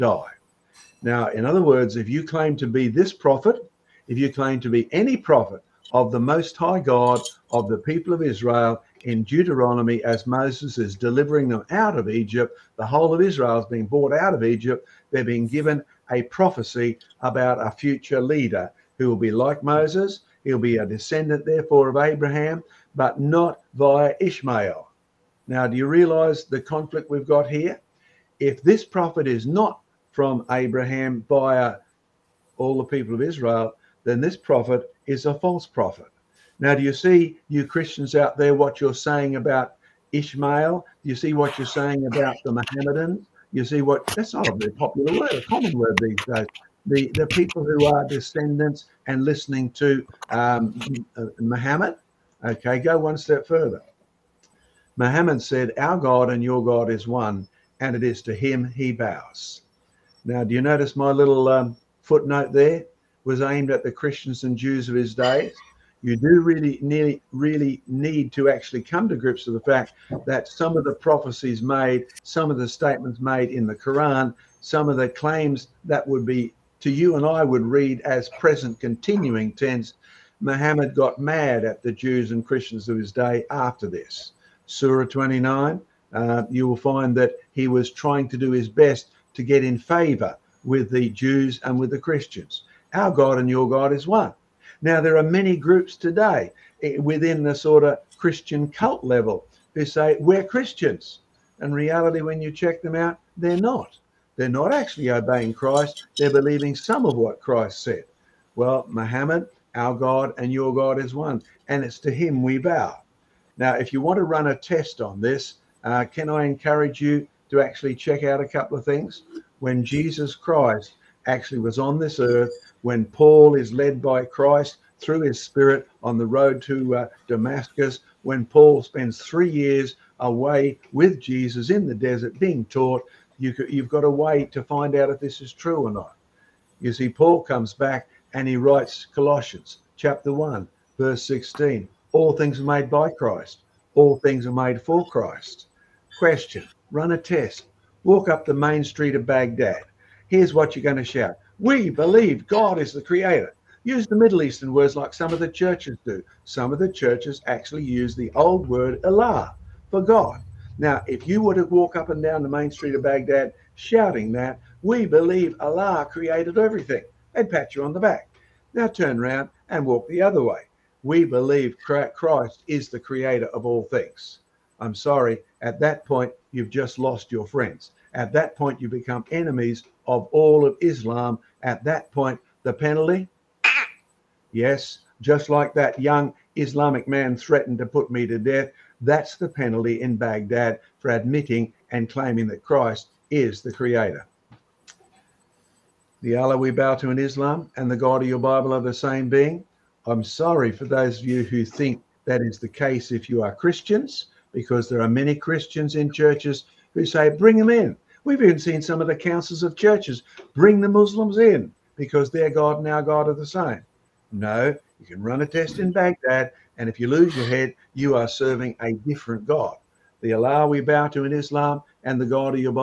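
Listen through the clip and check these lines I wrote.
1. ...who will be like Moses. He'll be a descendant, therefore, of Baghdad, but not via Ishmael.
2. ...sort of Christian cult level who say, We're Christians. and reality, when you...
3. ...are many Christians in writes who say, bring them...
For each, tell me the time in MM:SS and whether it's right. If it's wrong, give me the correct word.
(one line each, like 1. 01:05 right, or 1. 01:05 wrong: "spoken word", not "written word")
1. 00:18 wrong: "Abraham", not "Baghdad"
2. 01:37 right
3. 03:25 wrong: "churches", not "writes".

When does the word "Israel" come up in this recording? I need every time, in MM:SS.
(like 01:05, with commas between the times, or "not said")
00:08, 00:13, 00:33.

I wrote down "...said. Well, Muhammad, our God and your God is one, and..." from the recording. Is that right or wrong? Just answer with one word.
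right.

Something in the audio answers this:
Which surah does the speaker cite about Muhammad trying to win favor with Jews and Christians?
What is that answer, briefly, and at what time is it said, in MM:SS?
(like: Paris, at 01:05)
29, at 01:24.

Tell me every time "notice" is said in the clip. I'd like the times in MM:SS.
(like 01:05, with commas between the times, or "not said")
01:00.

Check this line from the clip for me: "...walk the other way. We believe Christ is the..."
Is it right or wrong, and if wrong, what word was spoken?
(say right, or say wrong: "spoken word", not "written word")
right.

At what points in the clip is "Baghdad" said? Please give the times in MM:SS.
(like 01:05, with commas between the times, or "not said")
02:29, 02:43, 03:10, 03:35.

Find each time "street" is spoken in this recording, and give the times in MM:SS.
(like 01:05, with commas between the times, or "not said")
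02:28, 02:42.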